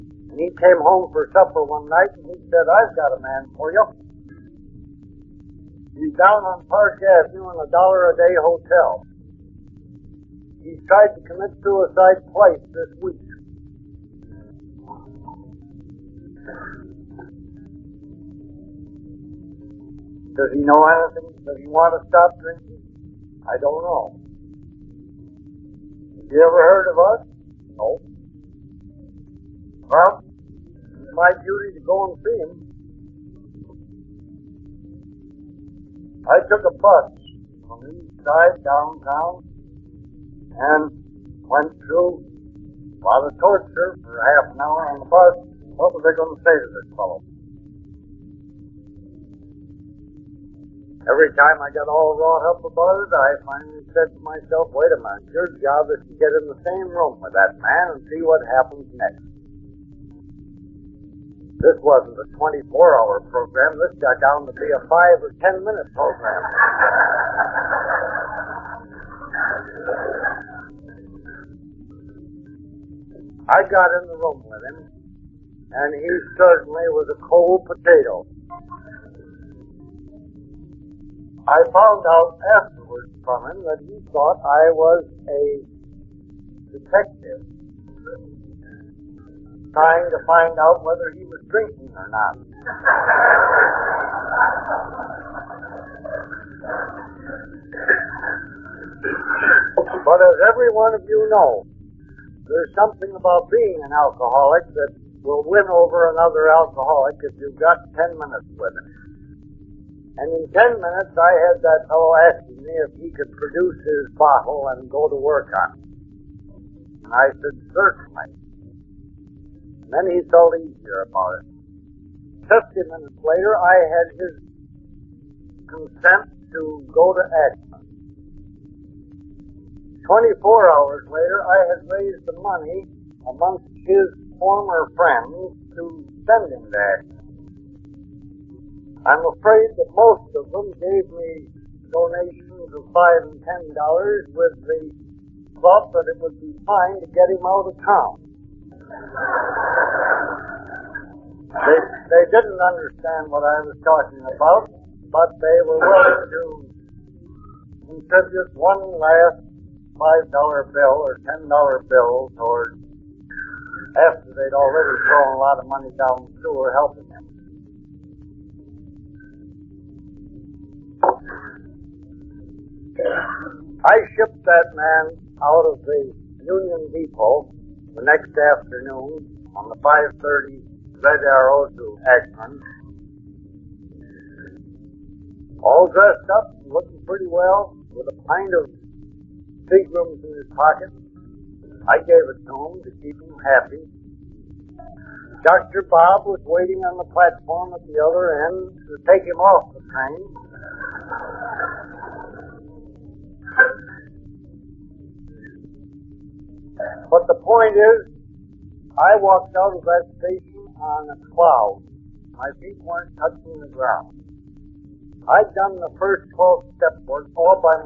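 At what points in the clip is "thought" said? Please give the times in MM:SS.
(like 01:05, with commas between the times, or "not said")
01:24, 02:25.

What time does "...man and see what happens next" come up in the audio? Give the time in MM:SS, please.
00:57.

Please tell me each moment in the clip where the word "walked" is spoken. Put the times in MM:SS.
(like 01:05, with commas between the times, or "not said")
03:29.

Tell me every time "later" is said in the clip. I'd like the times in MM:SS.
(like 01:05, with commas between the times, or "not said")
02:03, 02:11.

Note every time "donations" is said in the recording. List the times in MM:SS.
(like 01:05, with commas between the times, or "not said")
02:21.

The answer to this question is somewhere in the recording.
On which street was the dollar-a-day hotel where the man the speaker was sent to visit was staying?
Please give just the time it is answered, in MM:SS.
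00:06.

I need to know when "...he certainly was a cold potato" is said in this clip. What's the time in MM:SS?
01:15.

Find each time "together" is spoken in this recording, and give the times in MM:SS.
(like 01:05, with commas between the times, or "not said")
not said.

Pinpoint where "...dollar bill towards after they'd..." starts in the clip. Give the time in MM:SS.
02:41.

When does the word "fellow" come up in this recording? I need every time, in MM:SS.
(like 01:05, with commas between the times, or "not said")
00:46, 01:51.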